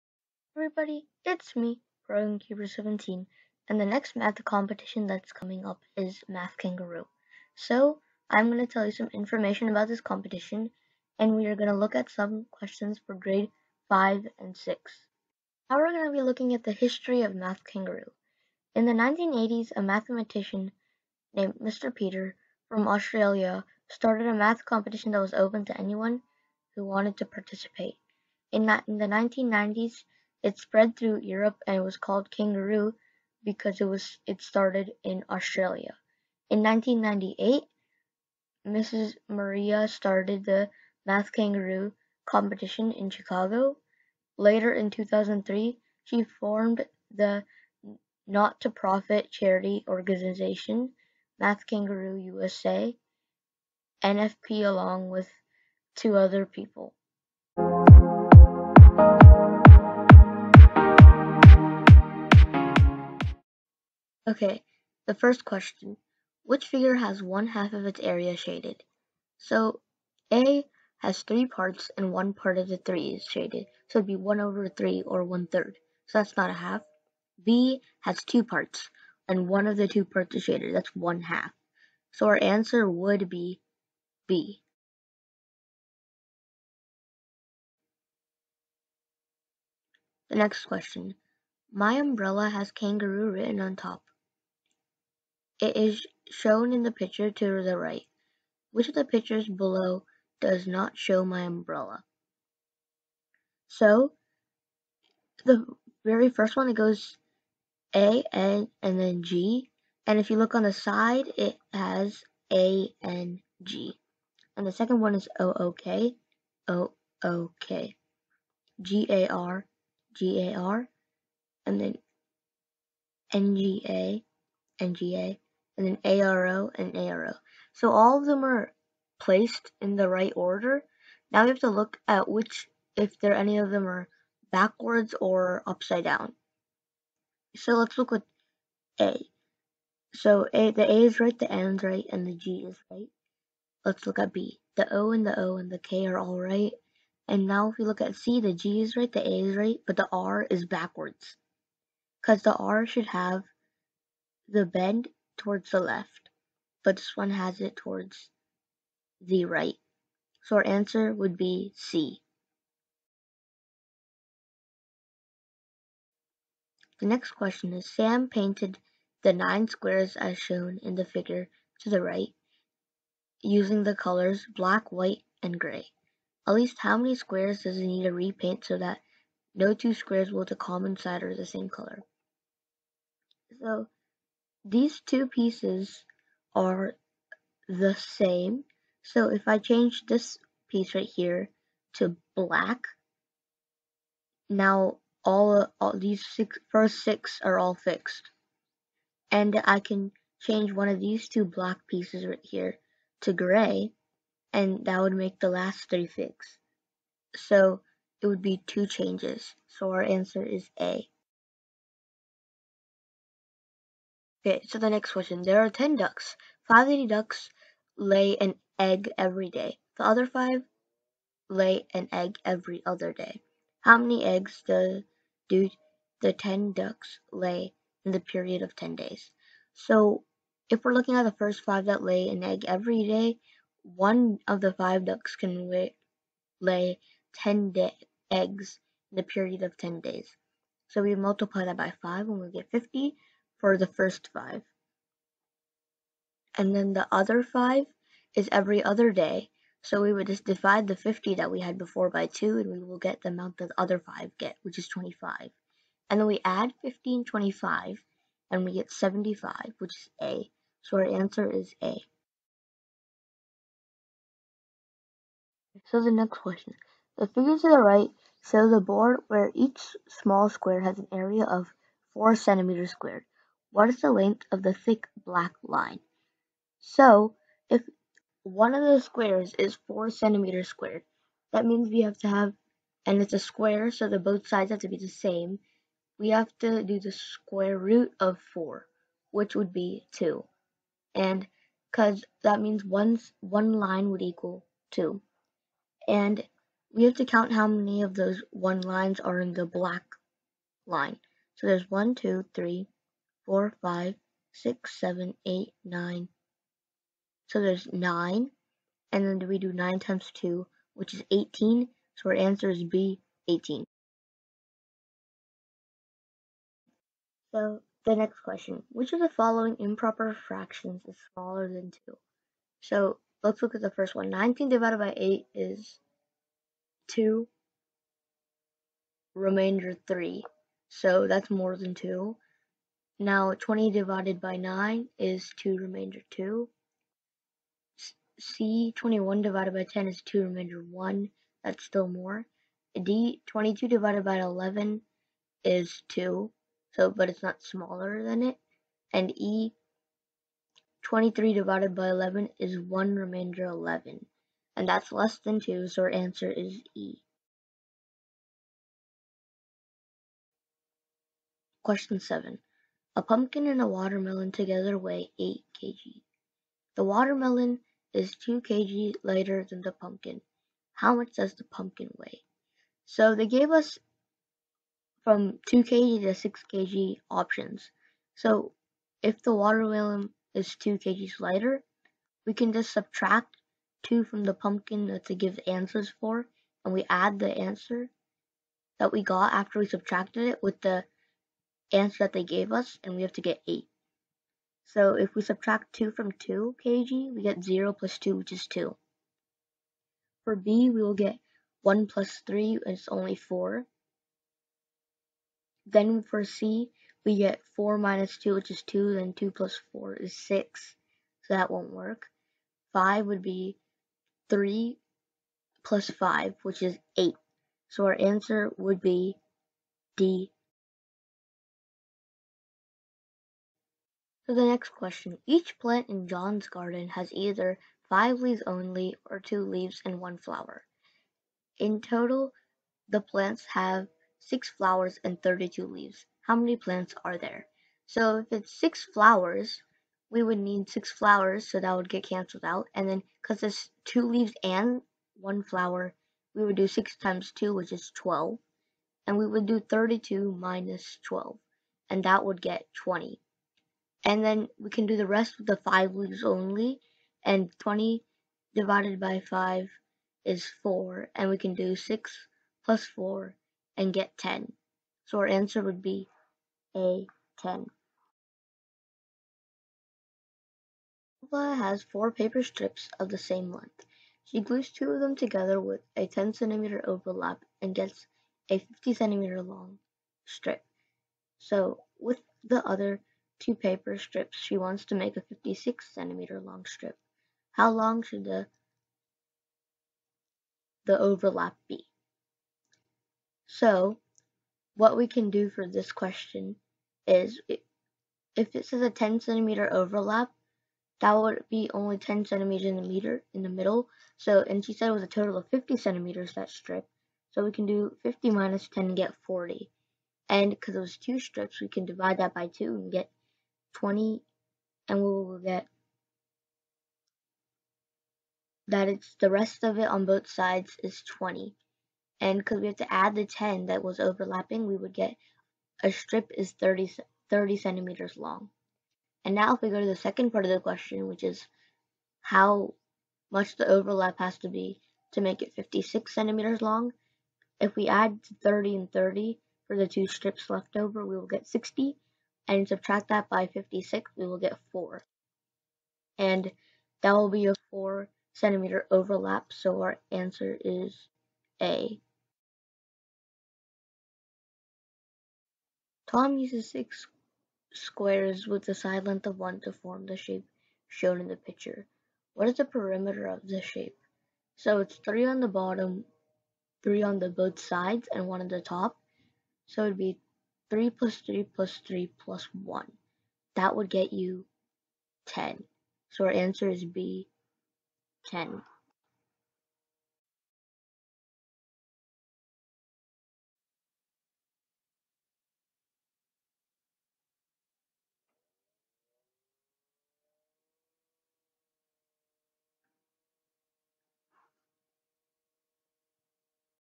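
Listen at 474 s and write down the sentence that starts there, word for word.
She glues two of them together with a 10 centimeter overlap and gets a 50 centimeter long strip.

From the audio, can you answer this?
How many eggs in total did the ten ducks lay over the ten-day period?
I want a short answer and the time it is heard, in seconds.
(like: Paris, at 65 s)
75, at 258 s.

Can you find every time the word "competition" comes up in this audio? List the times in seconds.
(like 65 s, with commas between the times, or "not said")
4 s, 10 s, 24 s, 42 s.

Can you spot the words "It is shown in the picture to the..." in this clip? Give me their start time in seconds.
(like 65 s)
95 s.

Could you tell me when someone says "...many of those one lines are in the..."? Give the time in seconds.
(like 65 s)
297 s.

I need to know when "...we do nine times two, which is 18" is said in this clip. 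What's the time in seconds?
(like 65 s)
309 s.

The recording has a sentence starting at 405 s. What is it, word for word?
Then for C, we get 4 minus 2, which is 2, then 2 plus 4 is 6, so that won't work.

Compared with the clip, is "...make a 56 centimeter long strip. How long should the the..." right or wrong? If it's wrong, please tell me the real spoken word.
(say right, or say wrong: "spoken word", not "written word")
right.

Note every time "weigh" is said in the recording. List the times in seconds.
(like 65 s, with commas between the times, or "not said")
364 s, 372 s.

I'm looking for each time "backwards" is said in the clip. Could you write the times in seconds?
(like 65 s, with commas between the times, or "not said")
134 s, 150 s.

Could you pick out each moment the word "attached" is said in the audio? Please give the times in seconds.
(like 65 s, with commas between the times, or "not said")
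not said.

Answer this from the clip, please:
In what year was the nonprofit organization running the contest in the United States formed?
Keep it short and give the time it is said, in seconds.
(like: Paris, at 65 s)
2003, at 44 s.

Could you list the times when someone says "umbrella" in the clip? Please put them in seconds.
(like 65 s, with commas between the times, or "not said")
91 s, 101 s.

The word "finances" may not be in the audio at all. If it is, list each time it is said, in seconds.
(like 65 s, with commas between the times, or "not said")
not said.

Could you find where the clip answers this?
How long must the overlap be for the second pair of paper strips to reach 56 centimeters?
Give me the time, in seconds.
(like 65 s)
547 s.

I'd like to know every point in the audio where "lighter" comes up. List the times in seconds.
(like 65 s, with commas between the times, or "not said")
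369 s, 381 s.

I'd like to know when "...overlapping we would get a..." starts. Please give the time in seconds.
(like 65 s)
524 s.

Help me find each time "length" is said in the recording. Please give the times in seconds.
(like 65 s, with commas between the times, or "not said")
274 s, 473 s, 559 s.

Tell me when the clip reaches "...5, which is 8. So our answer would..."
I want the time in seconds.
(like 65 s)
416 s.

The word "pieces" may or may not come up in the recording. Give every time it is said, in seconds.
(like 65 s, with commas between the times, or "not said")
185 s, 190 s, 201 s.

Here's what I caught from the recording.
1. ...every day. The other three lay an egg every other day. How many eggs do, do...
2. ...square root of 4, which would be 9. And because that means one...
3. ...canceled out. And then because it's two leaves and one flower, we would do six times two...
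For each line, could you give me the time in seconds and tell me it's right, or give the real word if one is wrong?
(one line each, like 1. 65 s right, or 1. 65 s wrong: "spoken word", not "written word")
1. 219 s wrong: "five", not "three"
2. 287 s wrong: "2", not "9"
3. 442 s right.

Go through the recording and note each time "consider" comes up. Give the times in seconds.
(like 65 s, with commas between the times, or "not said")
not said.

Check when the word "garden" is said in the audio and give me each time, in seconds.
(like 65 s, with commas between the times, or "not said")
426 s.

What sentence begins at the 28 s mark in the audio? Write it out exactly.
In, in the 1990s, it spread through Europe and was called kangaroo because it was it started in Australia.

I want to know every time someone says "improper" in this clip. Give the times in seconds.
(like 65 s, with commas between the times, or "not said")
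319 s.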